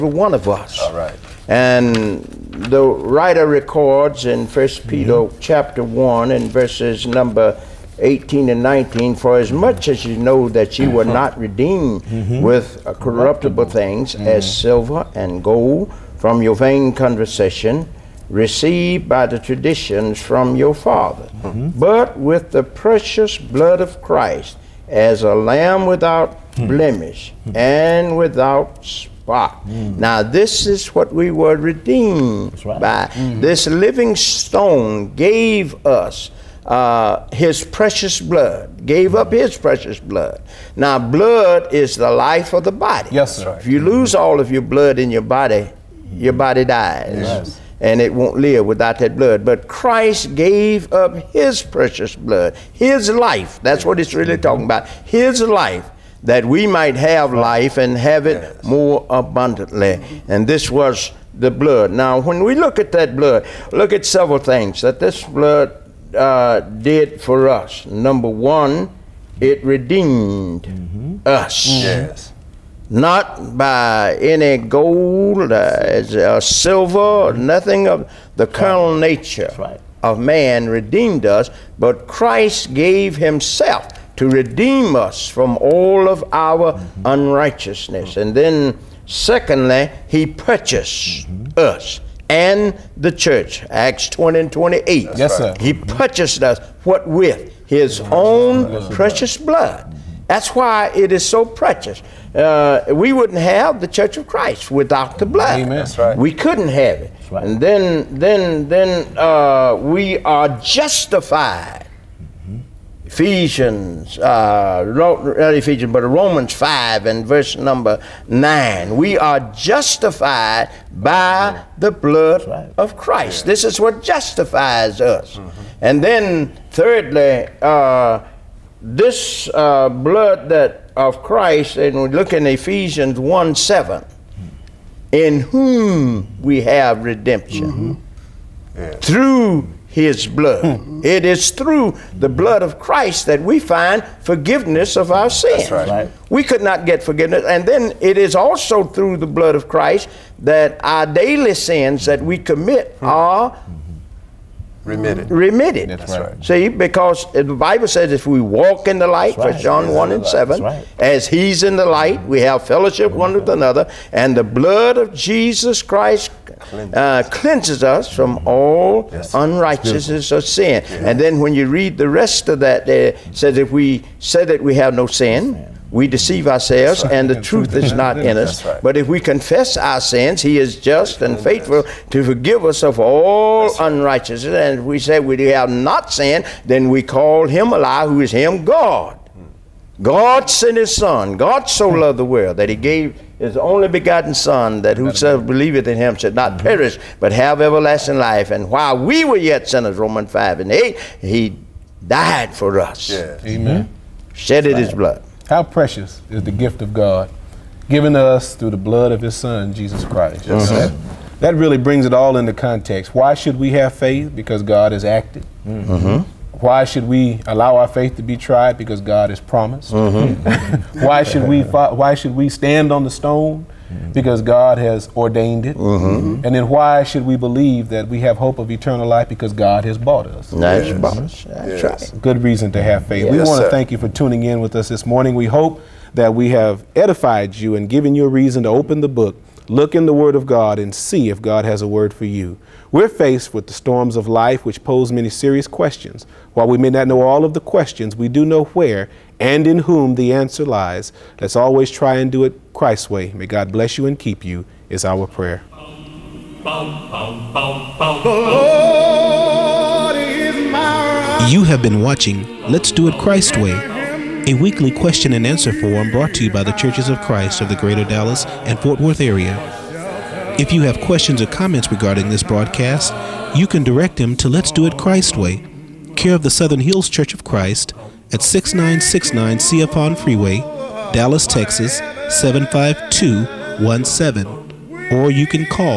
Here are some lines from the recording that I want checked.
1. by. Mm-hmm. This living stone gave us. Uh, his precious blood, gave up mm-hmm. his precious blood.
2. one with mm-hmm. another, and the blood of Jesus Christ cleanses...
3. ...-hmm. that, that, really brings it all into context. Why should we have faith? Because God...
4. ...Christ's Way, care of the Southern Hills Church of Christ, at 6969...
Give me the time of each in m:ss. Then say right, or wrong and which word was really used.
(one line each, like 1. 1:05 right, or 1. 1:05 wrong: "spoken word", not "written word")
1. 0:32 right
2. 2:43 right
3. 3:30 right
4. 4:34 right.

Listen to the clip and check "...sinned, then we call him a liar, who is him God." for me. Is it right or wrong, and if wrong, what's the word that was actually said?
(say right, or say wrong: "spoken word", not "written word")
right.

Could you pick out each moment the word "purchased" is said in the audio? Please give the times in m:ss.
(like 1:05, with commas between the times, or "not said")
1:30, 1:35.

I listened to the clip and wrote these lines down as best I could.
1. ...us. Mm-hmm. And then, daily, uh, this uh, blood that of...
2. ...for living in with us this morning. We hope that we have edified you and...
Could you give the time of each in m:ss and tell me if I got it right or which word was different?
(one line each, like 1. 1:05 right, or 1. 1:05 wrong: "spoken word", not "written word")
1. 2:04 wrong: "thirdly", not "daily"
2. 3:53 wrong: "tuning", not "living".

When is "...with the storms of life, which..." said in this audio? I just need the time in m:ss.
4:03.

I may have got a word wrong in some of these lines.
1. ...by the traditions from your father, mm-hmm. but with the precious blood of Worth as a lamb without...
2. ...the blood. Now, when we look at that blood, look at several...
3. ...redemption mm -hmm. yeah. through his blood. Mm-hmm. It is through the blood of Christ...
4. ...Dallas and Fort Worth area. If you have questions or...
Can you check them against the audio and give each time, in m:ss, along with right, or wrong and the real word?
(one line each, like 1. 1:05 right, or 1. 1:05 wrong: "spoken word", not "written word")
1. 0:19 wrong: "Christ", not "Worth"
2. 1:01 right
3. 2:17 right
4. 4:28 right.